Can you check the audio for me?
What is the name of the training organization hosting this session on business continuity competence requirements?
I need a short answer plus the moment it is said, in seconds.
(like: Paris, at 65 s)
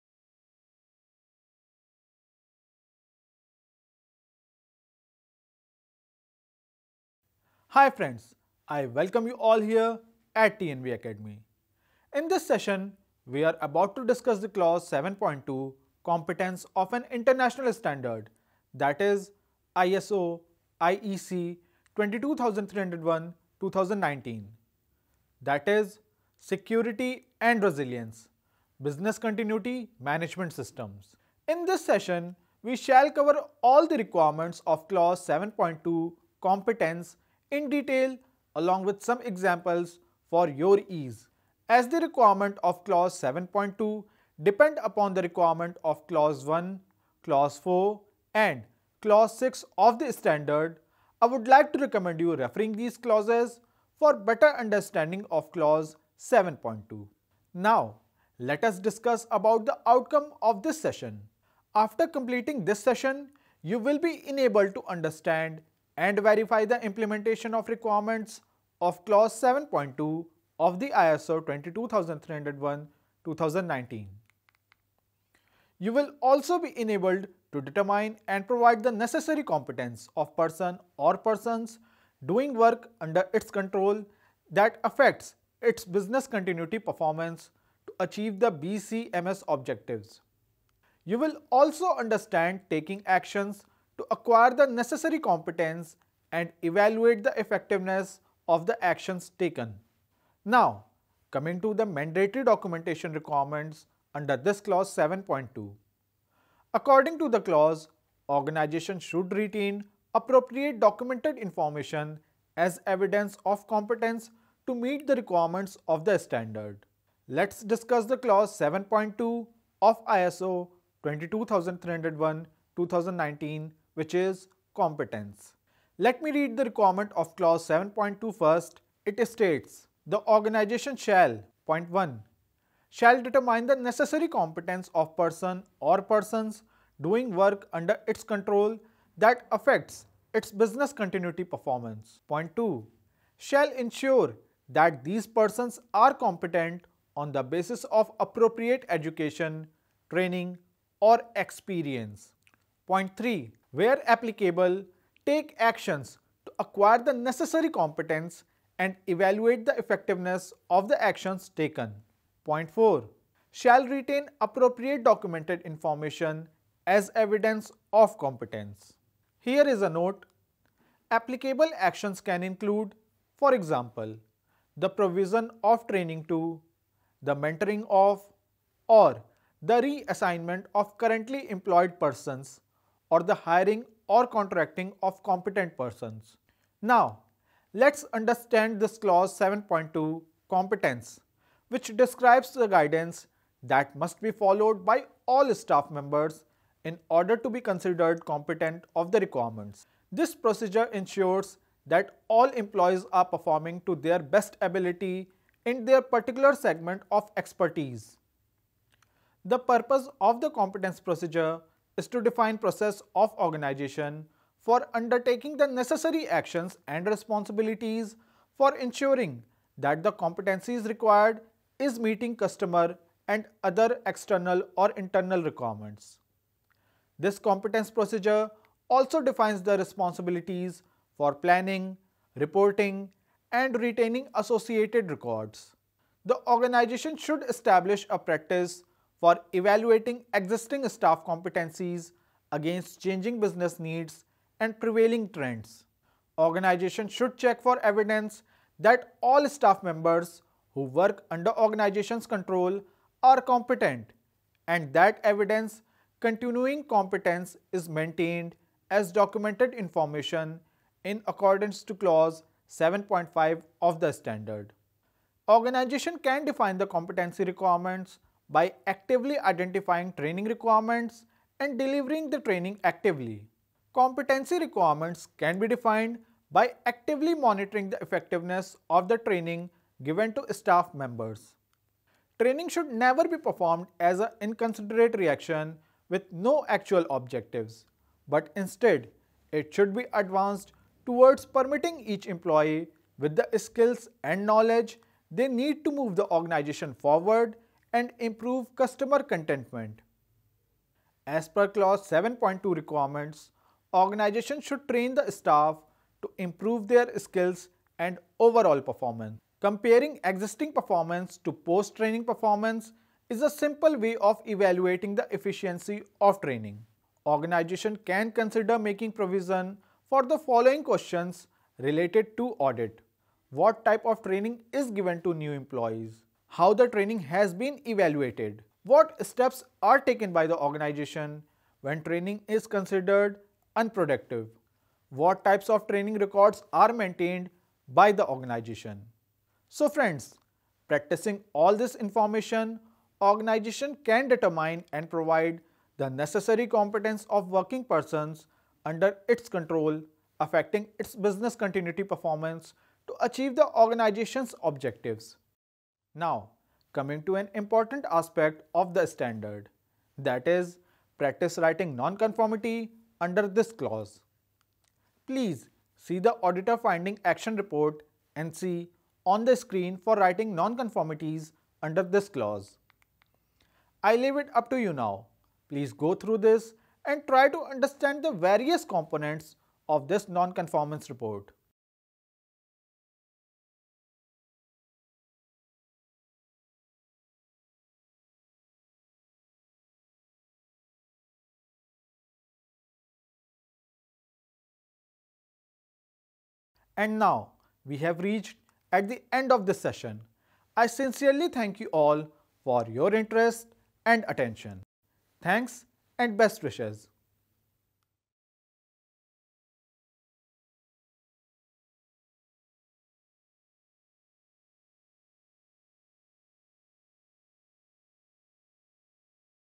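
TNV Akademi, at 10 s.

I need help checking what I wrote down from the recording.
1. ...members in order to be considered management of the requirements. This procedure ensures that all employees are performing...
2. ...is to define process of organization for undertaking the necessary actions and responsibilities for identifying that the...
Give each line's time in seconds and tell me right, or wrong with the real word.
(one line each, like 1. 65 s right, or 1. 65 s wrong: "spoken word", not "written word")
1. 195 s wrong: "competent", not "management"
2. 211 s wrong: "ensuring", not "identifying".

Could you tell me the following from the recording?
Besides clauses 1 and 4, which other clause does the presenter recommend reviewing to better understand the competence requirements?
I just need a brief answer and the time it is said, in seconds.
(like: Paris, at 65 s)
Clause 6, at 49 s.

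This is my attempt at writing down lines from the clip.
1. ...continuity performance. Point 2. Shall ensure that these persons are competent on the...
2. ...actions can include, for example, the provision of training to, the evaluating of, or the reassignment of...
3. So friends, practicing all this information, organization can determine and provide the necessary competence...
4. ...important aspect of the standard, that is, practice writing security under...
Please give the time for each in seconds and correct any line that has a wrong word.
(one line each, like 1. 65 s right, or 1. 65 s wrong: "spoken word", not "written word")
1. 140 s right
2. 171 s wrong: "mentoring", not "evaluating"
3. 339 s right
4. 357 s wrong: "nonconformity", not "security".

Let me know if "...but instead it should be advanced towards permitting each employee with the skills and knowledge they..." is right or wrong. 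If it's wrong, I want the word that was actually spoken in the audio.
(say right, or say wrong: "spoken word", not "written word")
right.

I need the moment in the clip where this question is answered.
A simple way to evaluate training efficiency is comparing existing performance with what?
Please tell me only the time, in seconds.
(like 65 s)
311 s.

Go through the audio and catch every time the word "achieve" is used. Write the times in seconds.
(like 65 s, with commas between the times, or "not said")
87 s, 353 s.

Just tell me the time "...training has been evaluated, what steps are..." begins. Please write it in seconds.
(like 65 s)
326 s.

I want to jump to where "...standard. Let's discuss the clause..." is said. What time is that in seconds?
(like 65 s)
116 s.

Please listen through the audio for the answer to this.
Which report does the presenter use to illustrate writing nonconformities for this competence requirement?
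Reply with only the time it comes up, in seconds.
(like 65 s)
366 s.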